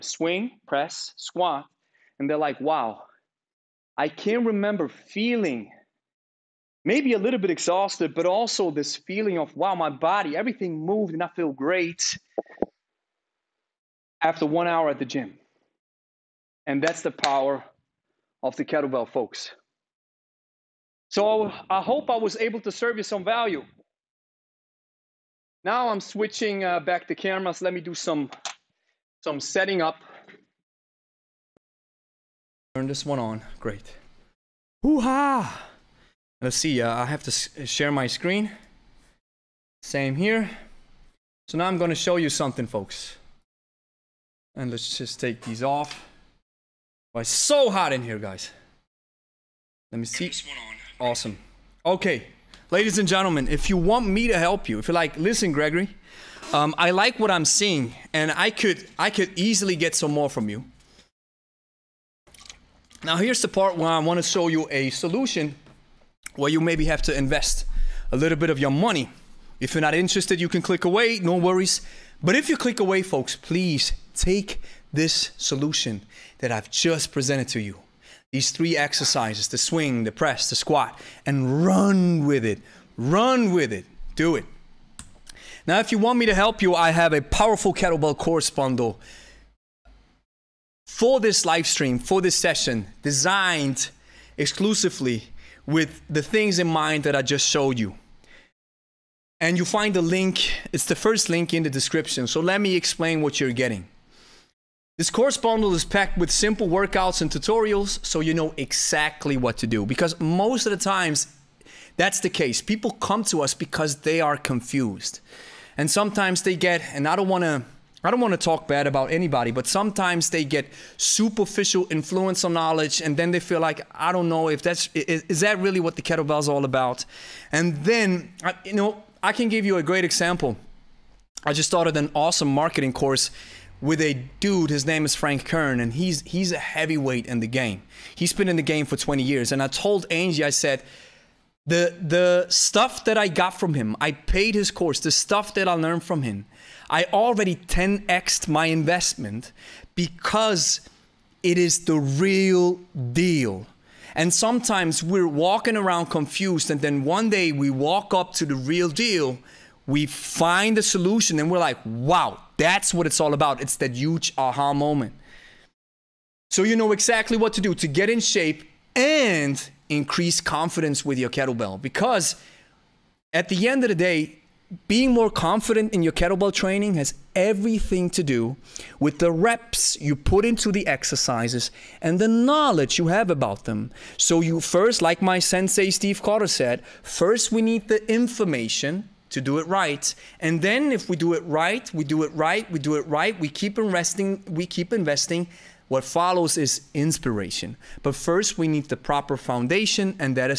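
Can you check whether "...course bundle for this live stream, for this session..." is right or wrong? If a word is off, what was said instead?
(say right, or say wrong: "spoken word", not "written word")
right.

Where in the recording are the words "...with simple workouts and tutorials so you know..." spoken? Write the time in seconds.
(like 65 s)
106 s.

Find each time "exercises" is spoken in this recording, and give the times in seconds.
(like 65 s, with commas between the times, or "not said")
78 s, 180 s.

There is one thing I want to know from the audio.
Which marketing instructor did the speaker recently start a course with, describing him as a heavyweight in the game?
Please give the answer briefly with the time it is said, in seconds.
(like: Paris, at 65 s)
Frank Kern, at 135 s.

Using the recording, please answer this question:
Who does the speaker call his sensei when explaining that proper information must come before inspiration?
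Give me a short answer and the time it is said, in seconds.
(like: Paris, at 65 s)
Steve Cotter, at 185 s.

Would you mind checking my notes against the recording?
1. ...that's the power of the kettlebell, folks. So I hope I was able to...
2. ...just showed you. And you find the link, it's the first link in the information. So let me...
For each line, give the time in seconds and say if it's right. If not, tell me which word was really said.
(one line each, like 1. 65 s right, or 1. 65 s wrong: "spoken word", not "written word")
1. 16 s right
2. 97 s wrong: "description", not "information".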